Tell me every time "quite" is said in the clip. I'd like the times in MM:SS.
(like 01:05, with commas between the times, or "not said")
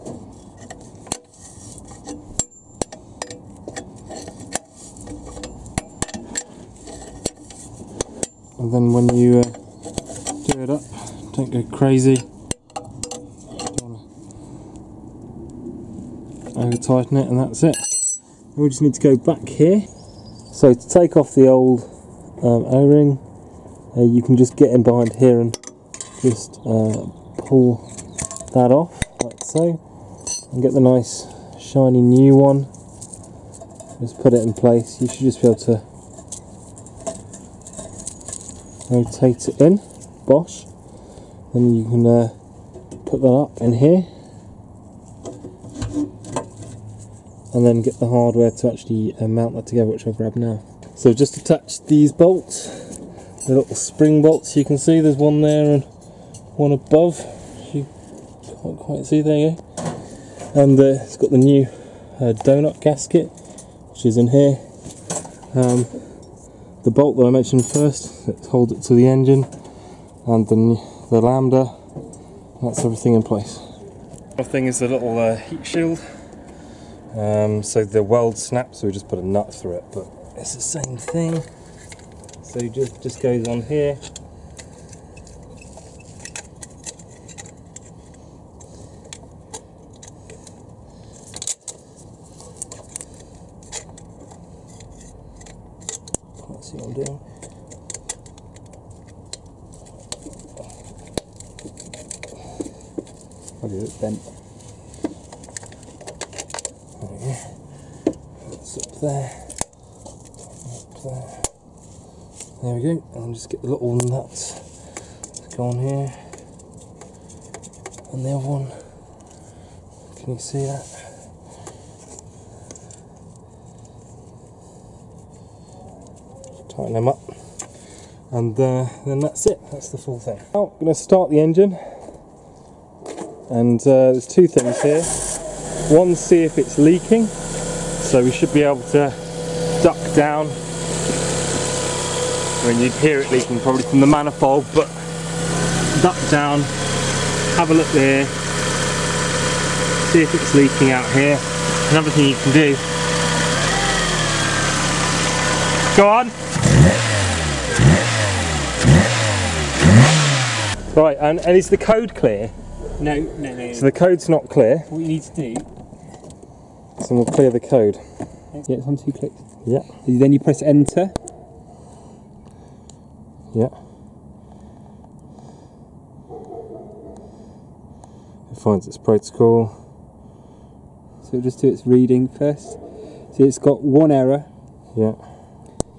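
00:58.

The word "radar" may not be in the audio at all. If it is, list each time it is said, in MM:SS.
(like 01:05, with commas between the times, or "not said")
not said.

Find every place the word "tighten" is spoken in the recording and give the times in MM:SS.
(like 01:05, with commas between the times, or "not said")
00:16, 02:06.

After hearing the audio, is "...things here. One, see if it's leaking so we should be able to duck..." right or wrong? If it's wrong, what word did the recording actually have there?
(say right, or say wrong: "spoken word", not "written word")
right.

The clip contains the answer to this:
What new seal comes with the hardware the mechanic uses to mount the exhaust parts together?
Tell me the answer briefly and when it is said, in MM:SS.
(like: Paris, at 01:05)
Donut gasket, at 01:02.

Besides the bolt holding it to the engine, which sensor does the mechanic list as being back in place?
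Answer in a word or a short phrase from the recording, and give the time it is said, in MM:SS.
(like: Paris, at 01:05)
Lambda, at 01:11.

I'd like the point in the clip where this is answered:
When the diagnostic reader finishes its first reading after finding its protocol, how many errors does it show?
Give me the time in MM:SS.
03:03.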